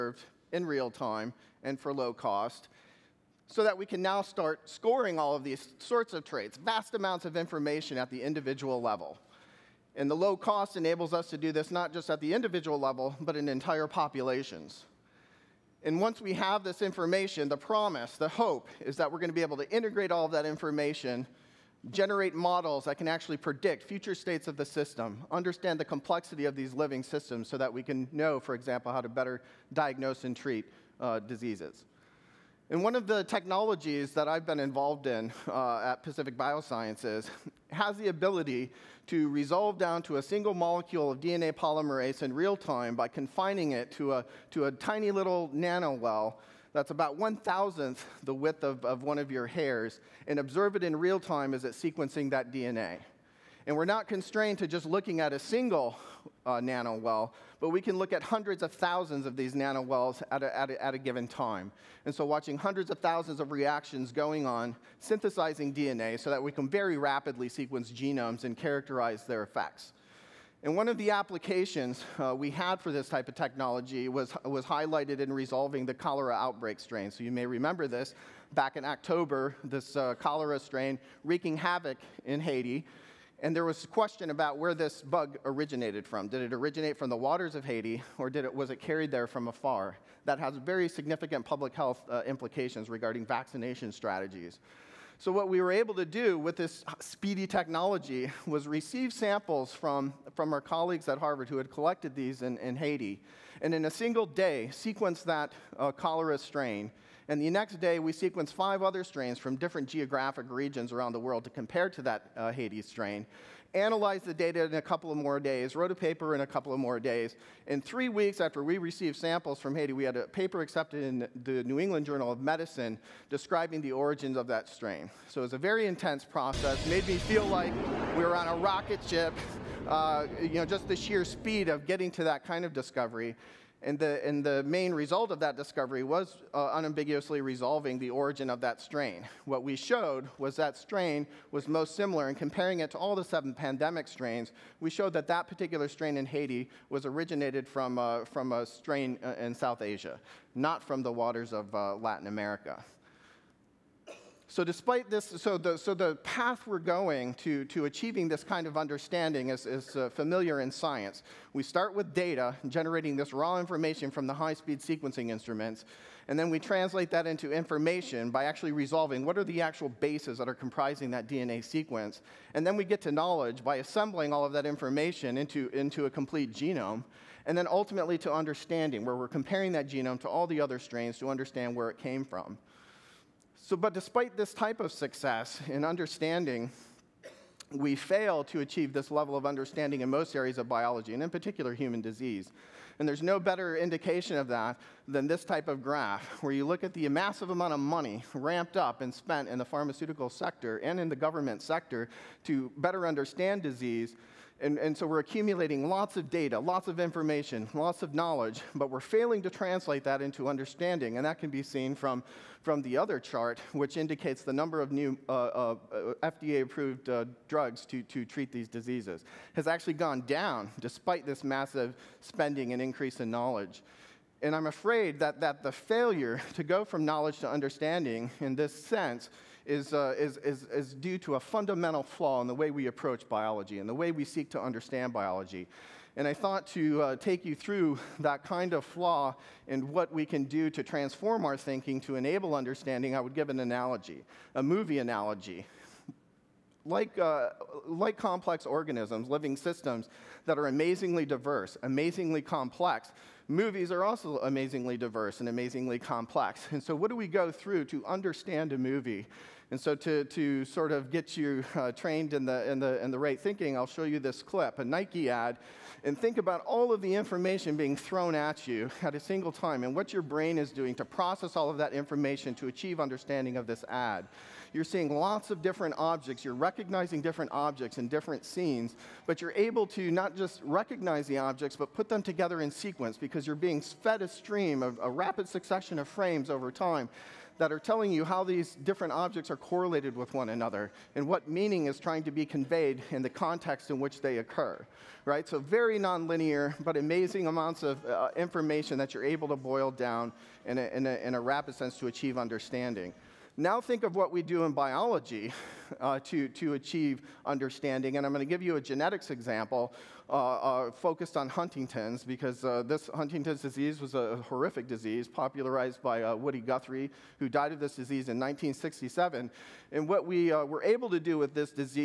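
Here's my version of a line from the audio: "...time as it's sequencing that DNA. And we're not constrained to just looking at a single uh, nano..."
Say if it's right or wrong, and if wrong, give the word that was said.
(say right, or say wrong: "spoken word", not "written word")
right.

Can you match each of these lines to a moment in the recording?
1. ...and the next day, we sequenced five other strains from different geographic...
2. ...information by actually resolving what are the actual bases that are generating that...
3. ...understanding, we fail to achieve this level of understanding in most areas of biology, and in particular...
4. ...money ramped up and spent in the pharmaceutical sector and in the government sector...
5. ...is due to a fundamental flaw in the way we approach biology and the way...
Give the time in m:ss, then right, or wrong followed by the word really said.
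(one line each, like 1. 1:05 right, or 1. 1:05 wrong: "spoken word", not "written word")
1. 1:47 right
2. 2:47 wrong: "comprising", not "generating"
3. 3:05 right
4. 3:17 right
5. 3:50 right.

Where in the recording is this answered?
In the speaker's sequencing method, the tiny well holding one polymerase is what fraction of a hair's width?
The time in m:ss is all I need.
0:47.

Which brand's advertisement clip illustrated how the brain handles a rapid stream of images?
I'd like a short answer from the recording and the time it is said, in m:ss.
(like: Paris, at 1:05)
Nike, at 4:24.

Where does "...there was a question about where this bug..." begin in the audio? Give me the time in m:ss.
1:23.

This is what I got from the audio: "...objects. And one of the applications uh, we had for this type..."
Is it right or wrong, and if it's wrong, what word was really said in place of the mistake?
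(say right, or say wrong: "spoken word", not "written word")
wrong: "effects", not "objects".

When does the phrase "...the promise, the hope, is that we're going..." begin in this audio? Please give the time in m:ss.
0:17.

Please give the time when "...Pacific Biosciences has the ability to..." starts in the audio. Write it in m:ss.
0:36.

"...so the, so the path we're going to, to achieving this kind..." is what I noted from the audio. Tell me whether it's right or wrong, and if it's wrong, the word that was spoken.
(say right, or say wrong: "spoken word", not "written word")
right.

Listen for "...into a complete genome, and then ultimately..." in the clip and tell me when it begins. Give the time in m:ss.
2:55.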